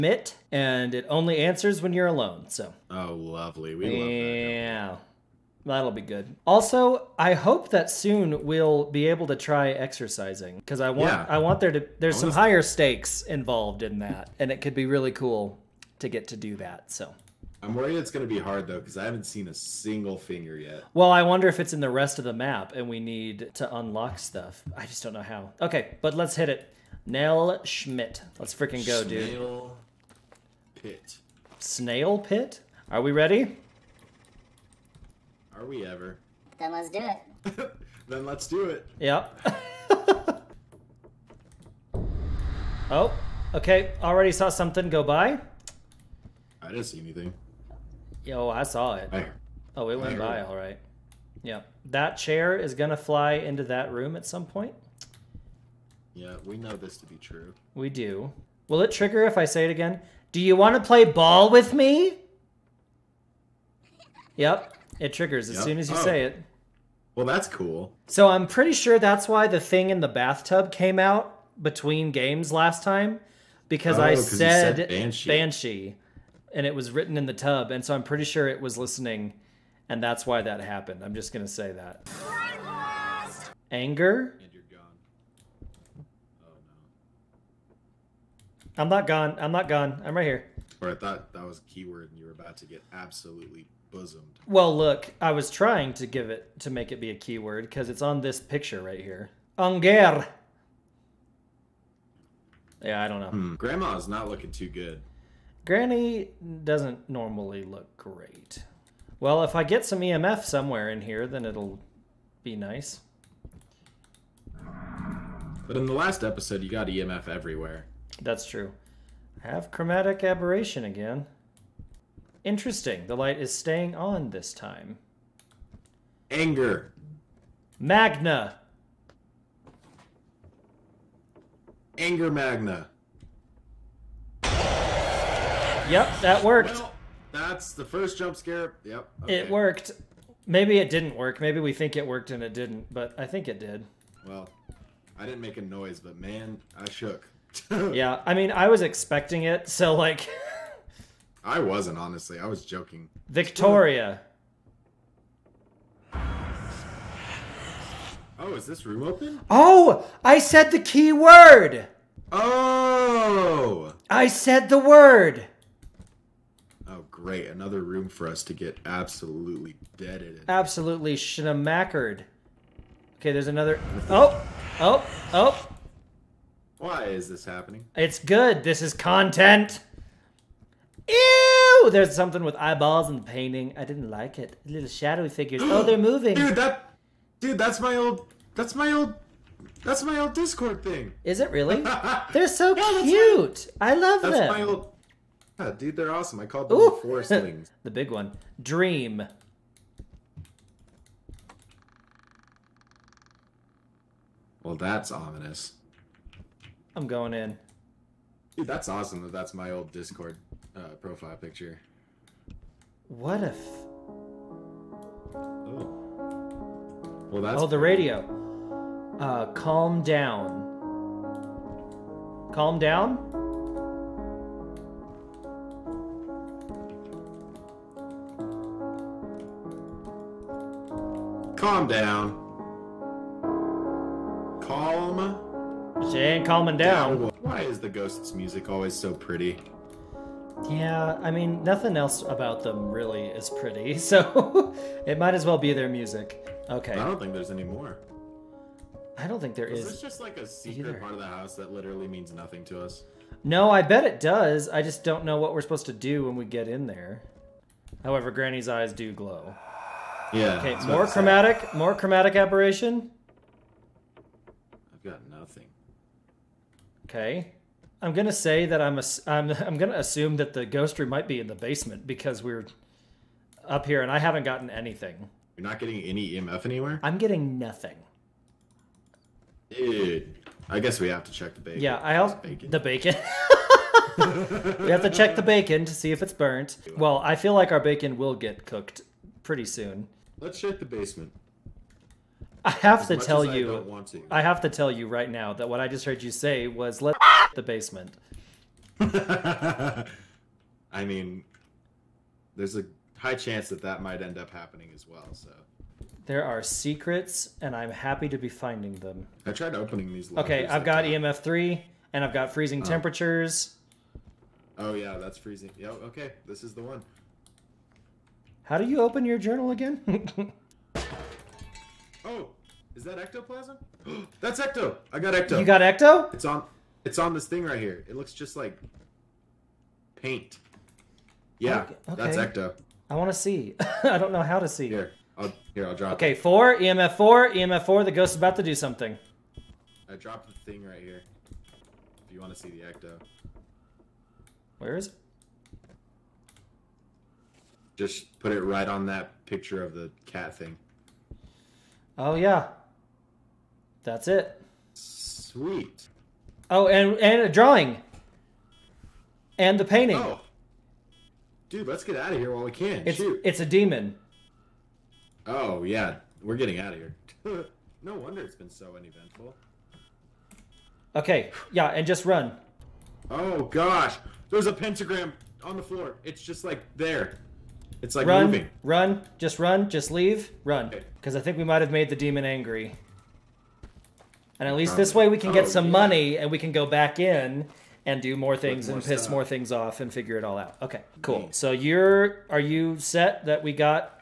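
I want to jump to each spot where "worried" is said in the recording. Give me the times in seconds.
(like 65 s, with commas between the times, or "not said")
17 s.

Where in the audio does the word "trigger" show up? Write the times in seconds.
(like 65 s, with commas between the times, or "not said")
58 s, 65 s.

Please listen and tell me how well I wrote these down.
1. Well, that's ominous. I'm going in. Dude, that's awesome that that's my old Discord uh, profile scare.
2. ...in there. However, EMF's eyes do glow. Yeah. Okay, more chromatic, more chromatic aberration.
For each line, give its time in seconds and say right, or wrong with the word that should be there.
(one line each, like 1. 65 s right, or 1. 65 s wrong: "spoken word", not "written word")
1. 204 s wrong: "picture", not "scare"
2. 256 s wrong: "Granny", not "EMF".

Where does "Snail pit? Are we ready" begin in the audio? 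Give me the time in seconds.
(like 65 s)
31 s.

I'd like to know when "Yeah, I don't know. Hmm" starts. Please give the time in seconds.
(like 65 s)
102 s.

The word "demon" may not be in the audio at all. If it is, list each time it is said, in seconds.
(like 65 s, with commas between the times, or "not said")
363 s, 382 s.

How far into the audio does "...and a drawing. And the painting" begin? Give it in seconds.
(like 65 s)
357 s.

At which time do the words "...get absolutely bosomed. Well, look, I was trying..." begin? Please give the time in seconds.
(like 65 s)
92 s.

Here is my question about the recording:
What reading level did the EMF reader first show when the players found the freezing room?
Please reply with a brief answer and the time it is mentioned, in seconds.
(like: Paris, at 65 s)
3, at 311 s.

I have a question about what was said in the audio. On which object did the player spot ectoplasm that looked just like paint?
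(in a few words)
picture of the cat thing.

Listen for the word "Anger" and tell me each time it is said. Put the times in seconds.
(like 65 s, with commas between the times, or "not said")
83 s, 99 s, 126 s, 131 s.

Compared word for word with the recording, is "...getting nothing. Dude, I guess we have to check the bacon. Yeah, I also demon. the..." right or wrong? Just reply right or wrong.
wrong.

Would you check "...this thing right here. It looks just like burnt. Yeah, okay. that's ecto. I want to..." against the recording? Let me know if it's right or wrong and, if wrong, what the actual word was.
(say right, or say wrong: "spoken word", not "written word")
wrong: "paint", not "burnt".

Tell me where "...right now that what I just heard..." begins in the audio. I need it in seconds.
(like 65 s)
295 s.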